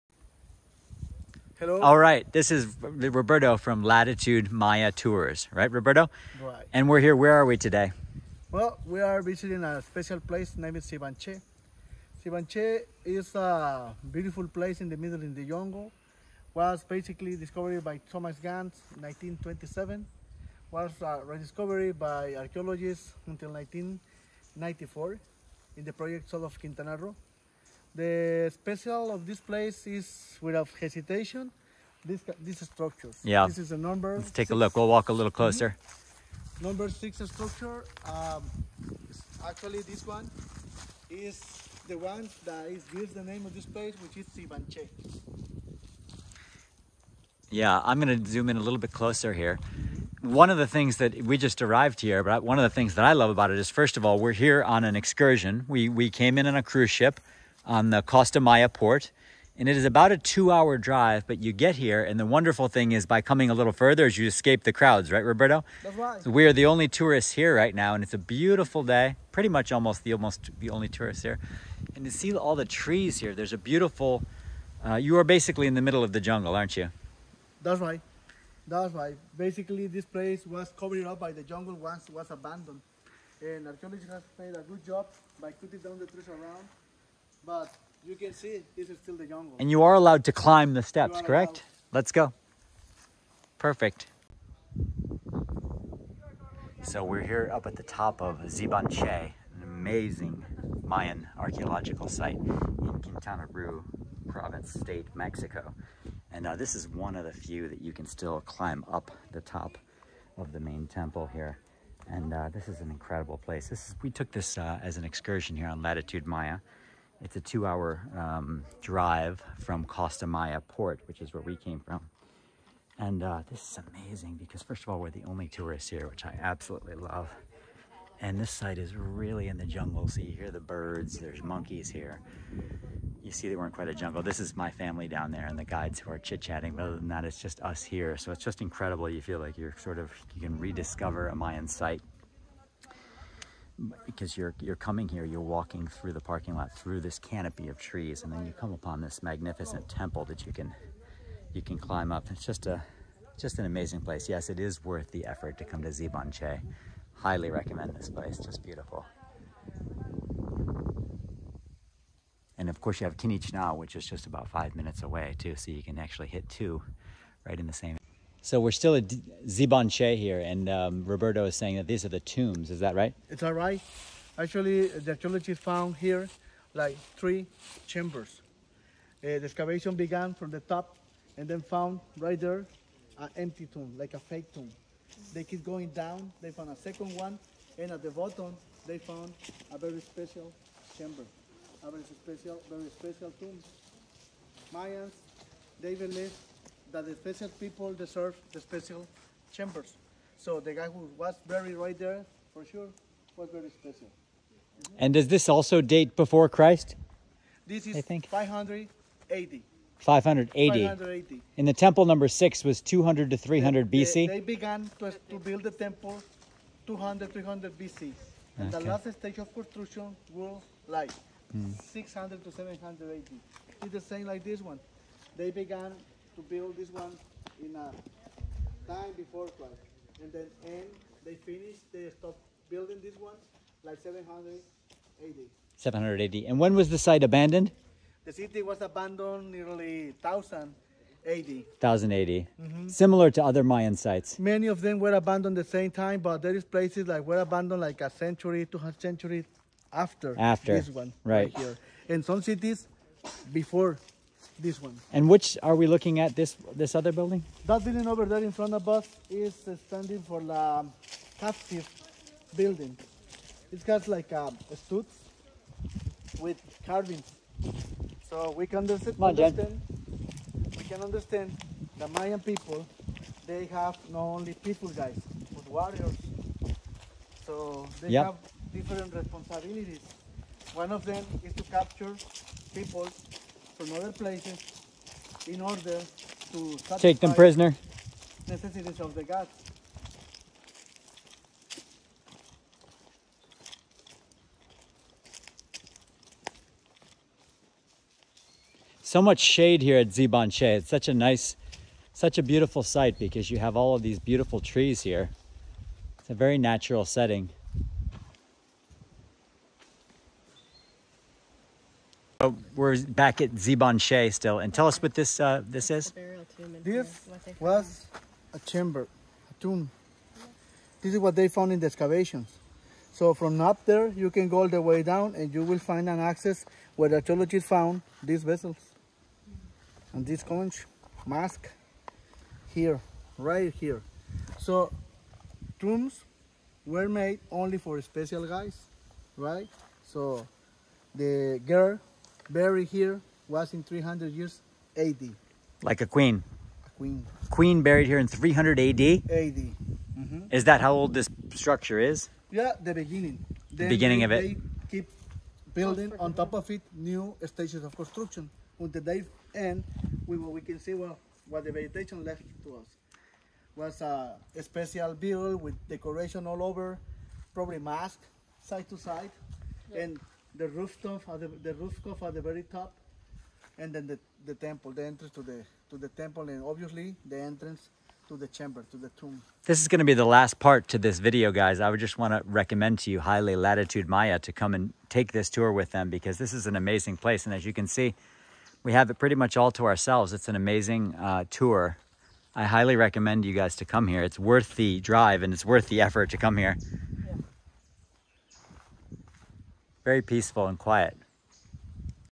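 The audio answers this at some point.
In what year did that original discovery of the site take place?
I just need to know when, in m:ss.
0:19.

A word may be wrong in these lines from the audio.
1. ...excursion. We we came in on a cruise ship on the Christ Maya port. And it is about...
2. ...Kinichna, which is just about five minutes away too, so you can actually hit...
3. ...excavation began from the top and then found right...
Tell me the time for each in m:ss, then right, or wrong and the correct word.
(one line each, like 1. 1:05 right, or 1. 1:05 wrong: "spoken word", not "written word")
1. 0:54 wrong: "Costa", not "Christ"
2. 2:43 right
3. 2:59 right.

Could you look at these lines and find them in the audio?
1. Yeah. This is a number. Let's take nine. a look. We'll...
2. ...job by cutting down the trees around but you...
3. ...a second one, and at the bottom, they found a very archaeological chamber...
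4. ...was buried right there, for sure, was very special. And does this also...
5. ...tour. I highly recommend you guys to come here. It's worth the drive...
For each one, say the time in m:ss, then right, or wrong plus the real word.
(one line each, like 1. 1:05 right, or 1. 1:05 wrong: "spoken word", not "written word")
1. 0:33 wrong: "six", not "nine"
2. 1:24 right
3. 3:06 wrong: "special", not "archaeological"
4. 3:21 right
5. 6:31 right.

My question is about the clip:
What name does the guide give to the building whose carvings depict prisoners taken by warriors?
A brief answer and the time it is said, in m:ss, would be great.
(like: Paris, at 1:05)
captive building, at 4:21.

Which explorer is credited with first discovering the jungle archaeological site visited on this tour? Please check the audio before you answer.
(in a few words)
Thomas Gann.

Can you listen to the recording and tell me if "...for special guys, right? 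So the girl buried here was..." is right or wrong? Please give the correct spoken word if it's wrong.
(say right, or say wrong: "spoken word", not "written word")
right.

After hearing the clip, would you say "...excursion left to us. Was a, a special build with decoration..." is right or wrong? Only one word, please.
wrong.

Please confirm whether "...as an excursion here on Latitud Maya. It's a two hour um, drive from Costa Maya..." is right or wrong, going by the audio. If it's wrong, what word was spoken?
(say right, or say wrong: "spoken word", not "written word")
right.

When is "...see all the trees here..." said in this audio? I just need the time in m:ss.
1:12.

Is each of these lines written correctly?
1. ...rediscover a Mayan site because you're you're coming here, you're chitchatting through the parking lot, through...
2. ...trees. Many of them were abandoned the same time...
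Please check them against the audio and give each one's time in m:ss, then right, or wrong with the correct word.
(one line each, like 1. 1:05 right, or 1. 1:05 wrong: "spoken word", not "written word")
1. 2:20 wrong: "walking", not "chitchatting"
2. 4:03 wrong: "sites", not "trees".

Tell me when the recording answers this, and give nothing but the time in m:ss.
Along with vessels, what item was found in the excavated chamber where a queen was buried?
5:30.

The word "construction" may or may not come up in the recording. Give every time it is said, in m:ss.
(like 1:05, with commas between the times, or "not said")
3:39, 5:57.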